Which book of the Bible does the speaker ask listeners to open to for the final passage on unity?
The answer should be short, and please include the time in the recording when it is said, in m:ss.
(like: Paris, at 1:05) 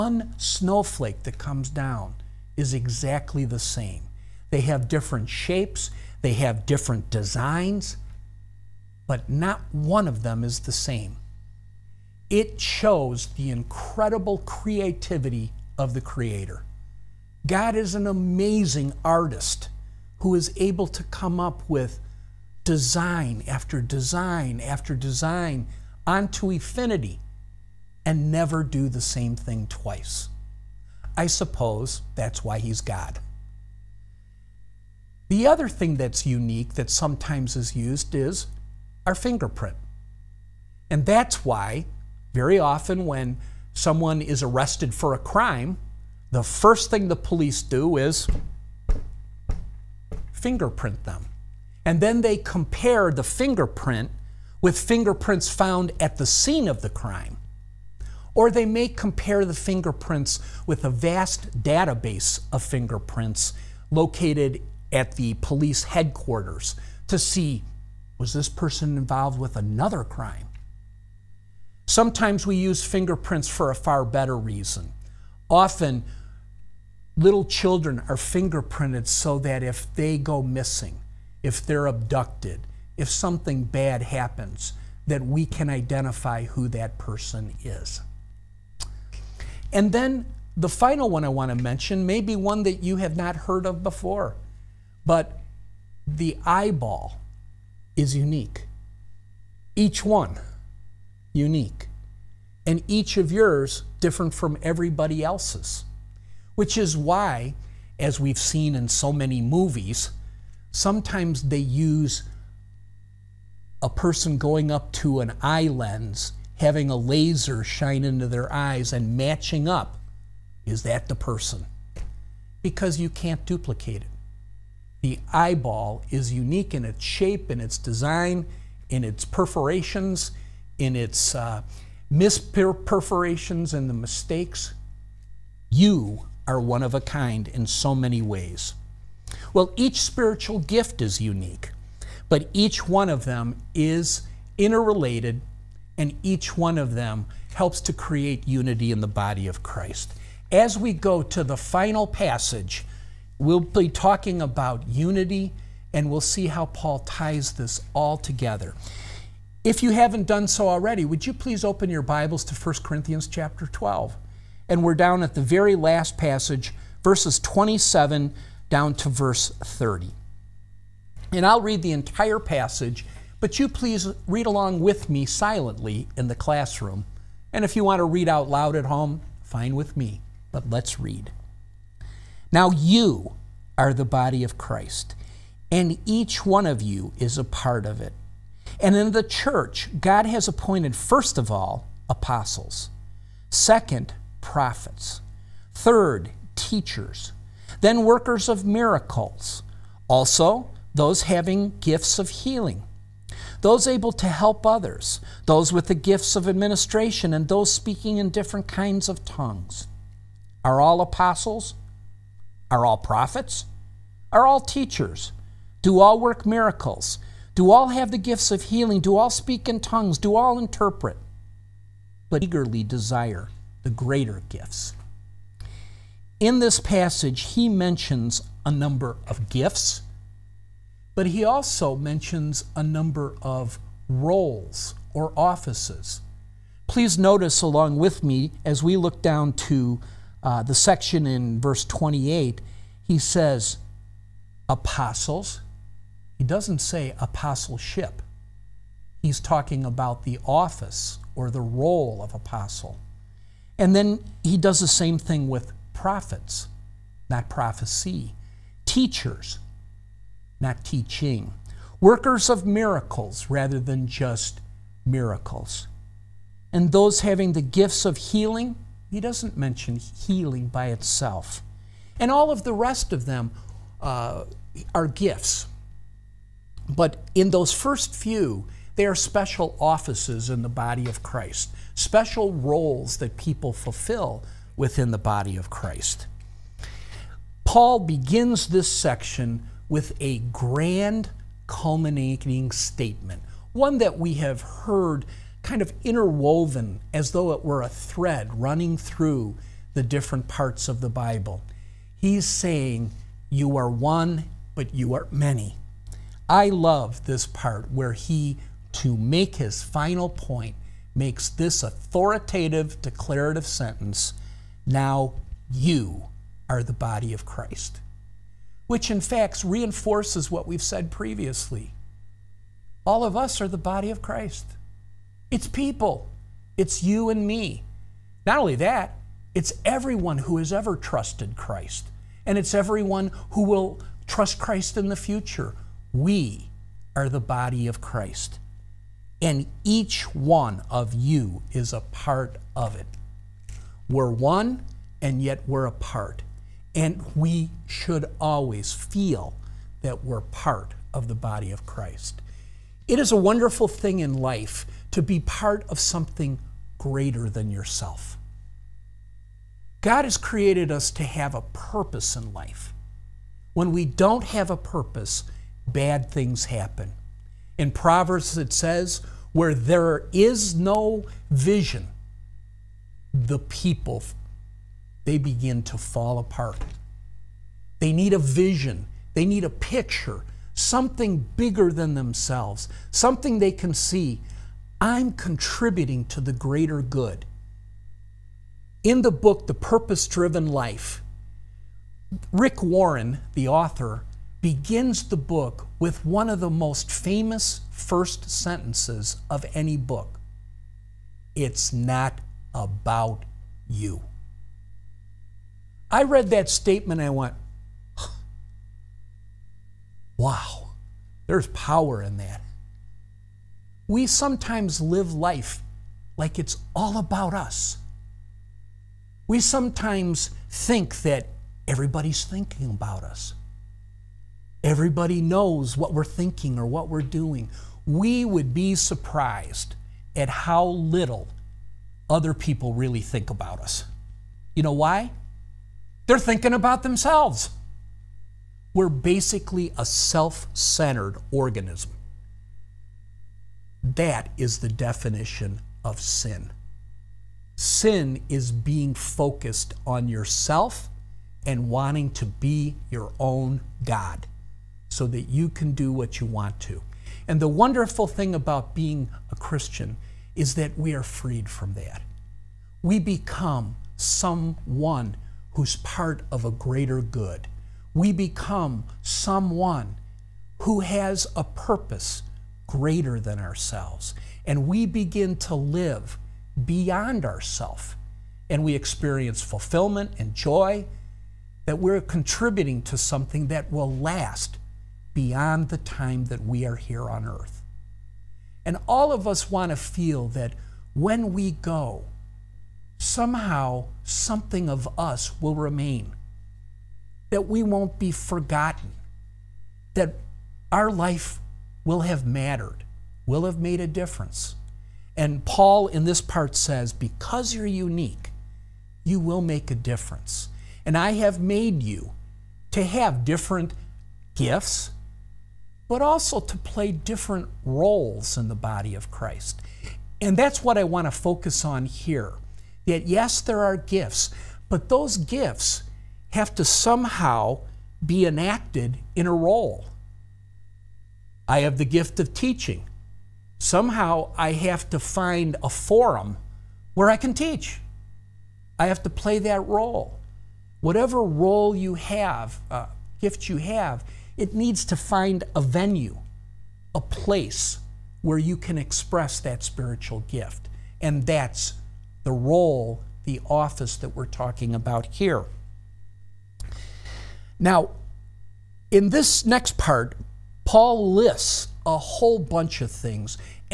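1 Corinthians, at 2:42.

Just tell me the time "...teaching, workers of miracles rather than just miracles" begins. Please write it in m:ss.
4:20.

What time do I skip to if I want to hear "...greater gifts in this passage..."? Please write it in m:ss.
3:43.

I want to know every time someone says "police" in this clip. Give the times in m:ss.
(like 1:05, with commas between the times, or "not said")
0:47, 1:05.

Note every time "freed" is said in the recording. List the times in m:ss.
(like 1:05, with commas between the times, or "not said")
7:41.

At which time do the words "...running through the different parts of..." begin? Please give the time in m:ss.
4:58.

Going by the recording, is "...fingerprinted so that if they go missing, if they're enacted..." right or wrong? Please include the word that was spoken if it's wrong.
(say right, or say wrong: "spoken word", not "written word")
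wrong: "abducted", not "enacted".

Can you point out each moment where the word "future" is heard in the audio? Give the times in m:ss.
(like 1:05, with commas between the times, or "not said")
5:35.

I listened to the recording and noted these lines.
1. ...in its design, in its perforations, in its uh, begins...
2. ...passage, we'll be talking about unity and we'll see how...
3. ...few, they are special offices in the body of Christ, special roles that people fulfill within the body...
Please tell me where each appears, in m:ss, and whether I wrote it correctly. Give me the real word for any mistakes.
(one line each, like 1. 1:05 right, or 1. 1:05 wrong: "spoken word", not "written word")
1. 2:07 wrong: "misperforations", not "begins"
2. 2:32 right
3. 4:38 right.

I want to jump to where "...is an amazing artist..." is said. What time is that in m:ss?
0:17.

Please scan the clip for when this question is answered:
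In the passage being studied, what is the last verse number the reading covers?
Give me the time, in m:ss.
2:49.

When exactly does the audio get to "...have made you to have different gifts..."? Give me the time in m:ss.
8:31.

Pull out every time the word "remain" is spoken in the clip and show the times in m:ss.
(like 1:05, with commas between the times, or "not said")
8:15.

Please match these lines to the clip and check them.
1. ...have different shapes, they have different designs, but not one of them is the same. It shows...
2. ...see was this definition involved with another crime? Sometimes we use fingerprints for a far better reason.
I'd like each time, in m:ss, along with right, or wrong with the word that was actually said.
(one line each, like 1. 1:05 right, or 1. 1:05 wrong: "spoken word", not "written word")
1. 0:04 right
2. 1:07 wrong: "person", not "definition".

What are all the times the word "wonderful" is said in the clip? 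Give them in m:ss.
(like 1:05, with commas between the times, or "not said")
5:53, 7:37.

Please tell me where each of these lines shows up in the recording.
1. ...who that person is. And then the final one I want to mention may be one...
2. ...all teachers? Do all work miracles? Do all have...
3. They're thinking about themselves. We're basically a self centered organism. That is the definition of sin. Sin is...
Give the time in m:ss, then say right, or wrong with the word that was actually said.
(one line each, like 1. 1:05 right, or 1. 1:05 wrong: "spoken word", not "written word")
1. 1:26 right
2. 3:34 right
3. 7:16 right.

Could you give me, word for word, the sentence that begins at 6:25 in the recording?
I'm contributing to the greater good.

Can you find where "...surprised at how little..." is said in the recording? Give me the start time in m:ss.
7:08.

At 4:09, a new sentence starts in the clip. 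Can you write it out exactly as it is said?
He's talking about the office or the role of apostle.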